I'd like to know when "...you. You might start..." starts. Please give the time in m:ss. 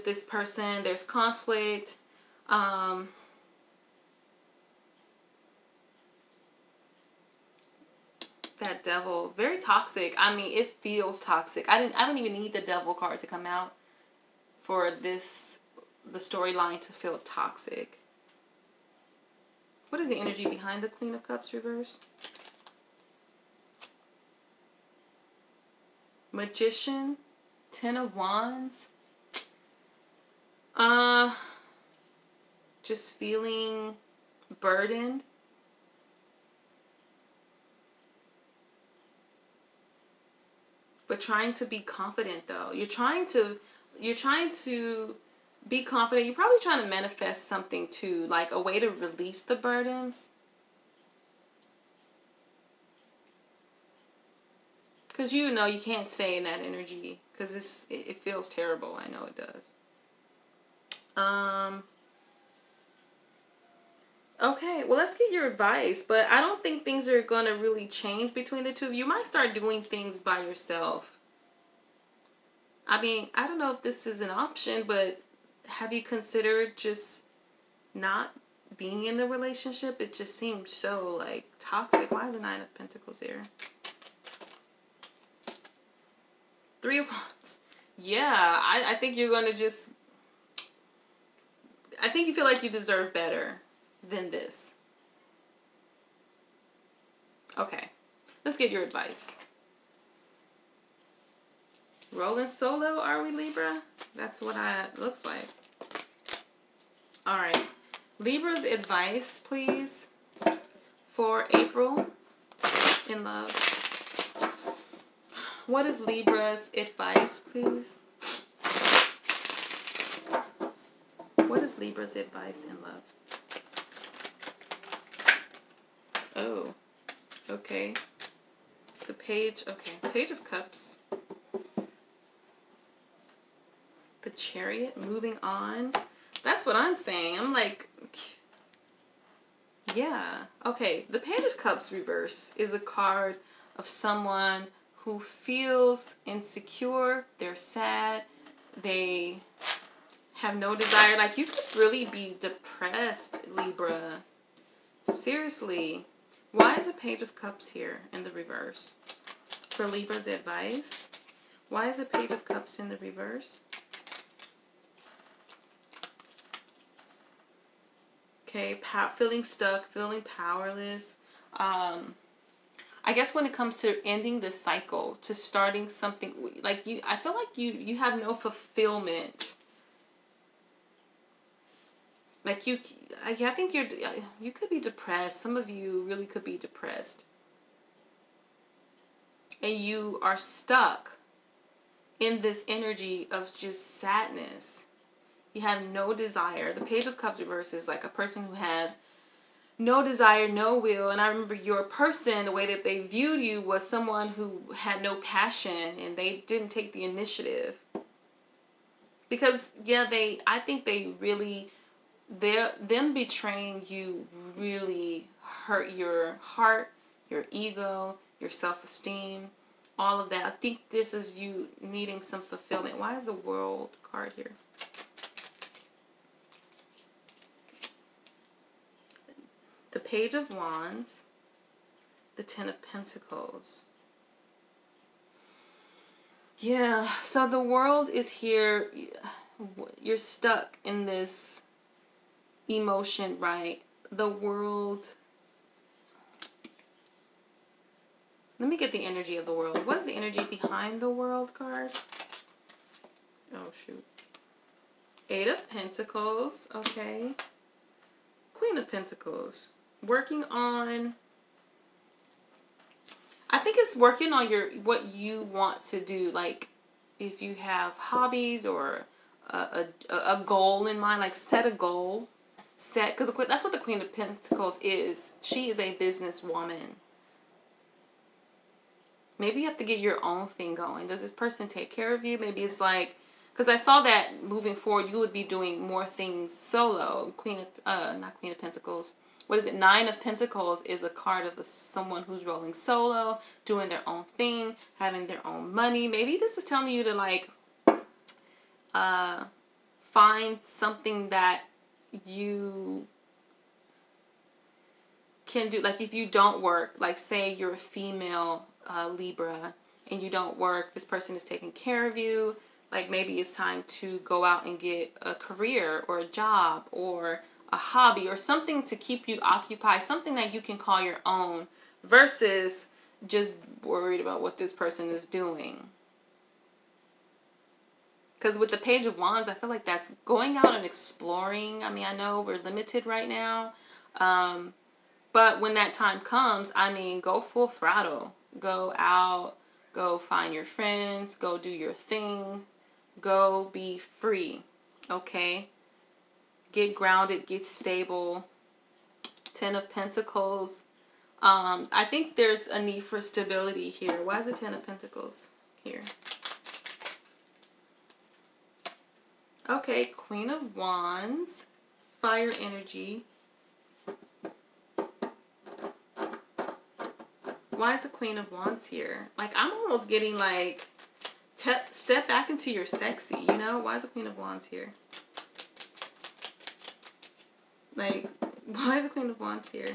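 1:08.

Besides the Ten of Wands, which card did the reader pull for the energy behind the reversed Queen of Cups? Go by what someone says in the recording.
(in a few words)
Magician.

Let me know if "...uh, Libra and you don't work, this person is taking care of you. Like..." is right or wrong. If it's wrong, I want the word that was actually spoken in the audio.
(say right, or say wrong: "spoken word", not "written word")
right.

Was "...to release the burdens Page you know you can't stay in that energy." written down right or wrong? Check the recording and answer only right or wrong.
wrong.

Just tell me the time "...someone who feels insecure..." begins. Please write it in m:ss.
2:23.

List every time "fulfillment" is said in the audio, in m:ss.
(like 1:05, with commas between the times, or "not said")
2:58, 3:42.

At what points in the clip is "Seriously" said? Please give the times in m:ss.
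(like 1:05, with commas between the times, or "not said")
2:35.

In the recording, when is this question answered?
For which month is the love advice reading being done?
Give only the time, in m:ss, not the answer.
1:51.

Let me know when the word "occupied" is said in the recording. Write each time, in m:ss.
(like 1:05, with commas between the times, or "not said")
5:19.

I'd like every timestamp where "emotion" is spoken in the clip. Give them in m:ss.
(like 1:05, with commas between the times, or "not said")
4:02.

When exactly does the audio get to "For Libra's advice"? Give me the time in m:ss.
2:39.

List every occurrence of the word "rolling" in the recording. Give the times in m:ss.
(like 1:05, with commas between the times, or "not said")
1:42, 4:52.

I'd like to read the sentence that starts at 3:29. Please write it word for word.
Because yeah, they I think they really their them betraying you really hurt your heart, your ego, your self-esteem, all of that.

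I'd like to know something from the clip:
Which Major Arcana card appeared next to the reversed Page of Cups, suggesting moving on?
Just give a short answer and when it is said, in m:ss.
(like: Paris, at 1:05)
The Chariot, at 2:14.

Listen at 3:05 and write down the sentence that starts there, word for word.
Some of you really could be depressed, and you are stuck in this energy of just sadness.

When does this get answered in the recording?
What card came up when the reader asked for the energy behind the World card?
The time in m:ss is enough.
4:15.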